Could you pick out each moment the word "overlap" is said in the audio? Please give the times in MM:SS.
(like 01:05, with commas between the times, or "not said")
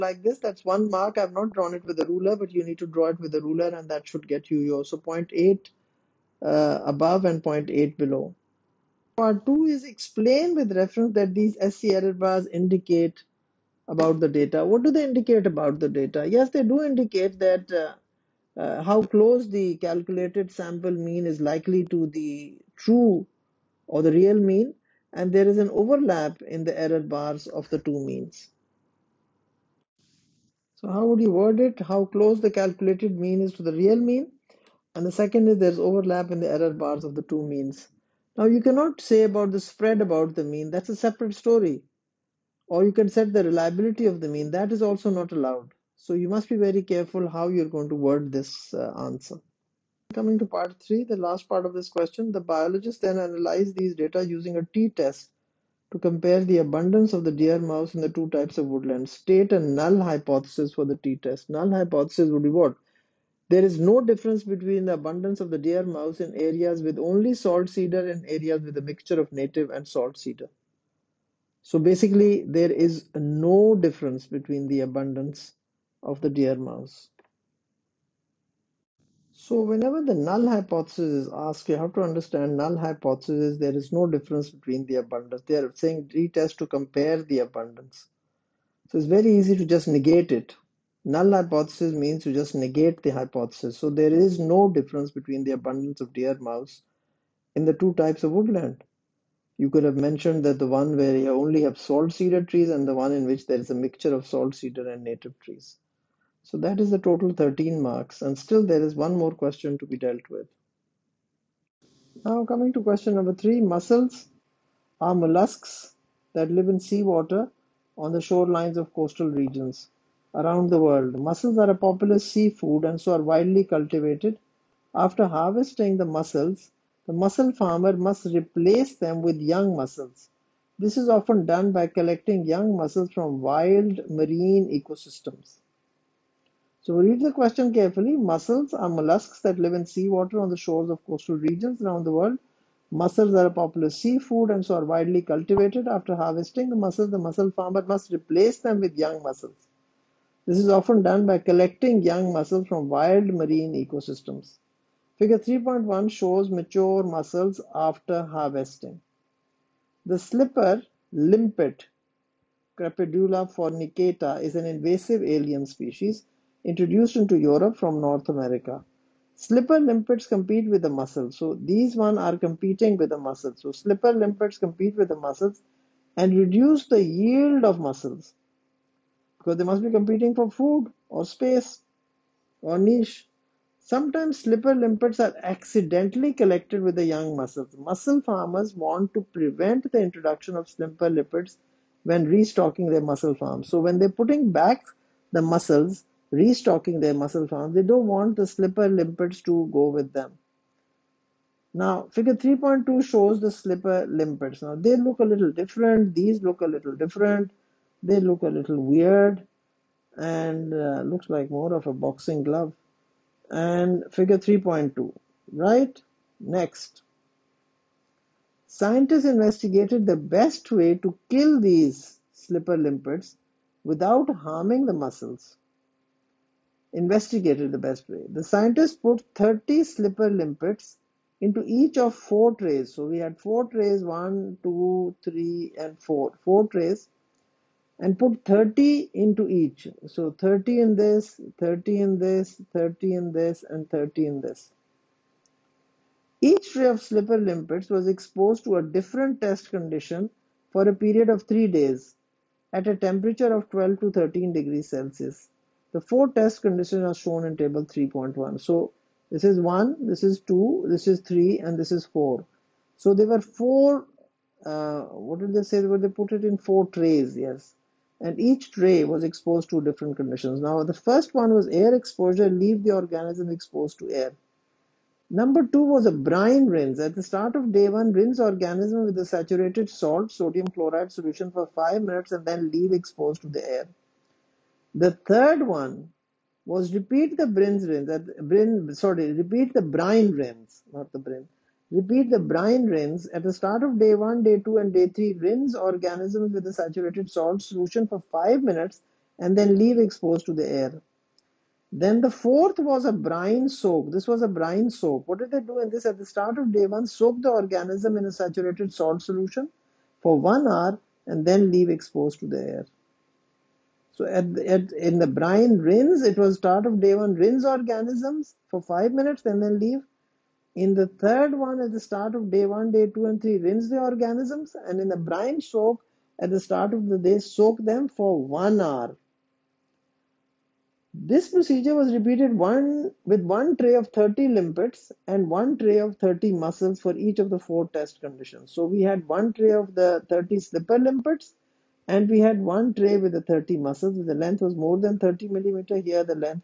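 00:25, 00:35.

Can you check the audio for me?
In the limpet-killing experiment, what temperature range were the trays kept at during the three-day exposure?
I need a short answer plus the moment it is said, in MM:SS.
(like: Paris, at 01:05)
12 to 13 degrees Celsius, at 04:13.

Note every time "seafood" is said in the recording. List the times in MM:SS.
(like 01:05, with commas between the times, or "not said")
02:02, 02:23.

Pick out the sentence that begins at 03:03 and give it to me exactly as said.
Sometimes slipper limpets are accidentally collected with the young mussels.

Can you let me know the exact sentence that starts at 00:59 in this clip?
State a null hypothesis for the t-test.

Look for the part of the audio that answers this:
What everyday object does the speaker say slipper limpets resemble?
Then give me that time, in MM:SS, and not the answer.
03:31.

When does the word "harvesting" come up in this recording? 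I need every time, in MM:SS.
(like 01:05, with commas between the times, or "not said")
02:05, 02:26, 02:38.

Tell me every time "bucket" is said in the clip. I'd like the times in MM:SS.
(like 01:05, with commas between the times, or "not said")
not said.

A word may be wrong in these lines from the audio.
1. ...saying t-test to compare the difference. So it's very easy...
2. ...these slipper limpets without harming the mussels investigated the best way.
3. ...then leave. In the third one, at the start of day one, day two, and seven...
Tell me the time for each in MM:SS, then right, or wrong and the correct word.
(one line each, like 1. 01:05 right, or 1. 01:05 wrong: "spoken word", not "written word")
1. 01:25 wrong: "abundance", not "difference"
2. 03:41 right
3. 05:19 wrong: "three", not "seven".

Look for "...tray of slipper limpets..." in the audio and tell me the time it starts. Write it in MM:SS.
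04:06.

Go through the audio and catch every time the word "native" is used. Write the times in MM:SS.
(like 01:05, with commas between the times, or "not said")
01:09, 01:45.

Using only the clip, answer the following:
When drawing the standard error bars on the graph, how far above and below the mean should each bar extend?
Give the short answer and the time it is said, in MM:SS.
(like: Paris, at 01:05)
0.8, at 00:04.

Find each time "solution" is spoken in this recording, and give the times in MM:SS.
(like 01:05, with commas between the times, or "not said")
04:41, 04:57, 05:09.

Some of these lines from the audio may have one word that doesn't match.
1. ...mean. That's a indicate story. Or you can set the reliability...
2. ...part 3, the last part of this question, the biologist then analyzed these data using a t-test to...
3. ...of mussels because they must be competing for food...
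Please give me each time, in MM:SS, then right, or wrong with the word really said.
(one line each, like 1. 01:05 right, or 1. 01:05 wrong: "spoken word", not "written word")
1. 00:40 wrong: "separate", not "indicate"
2. 00:50 right
3. 02:57 right.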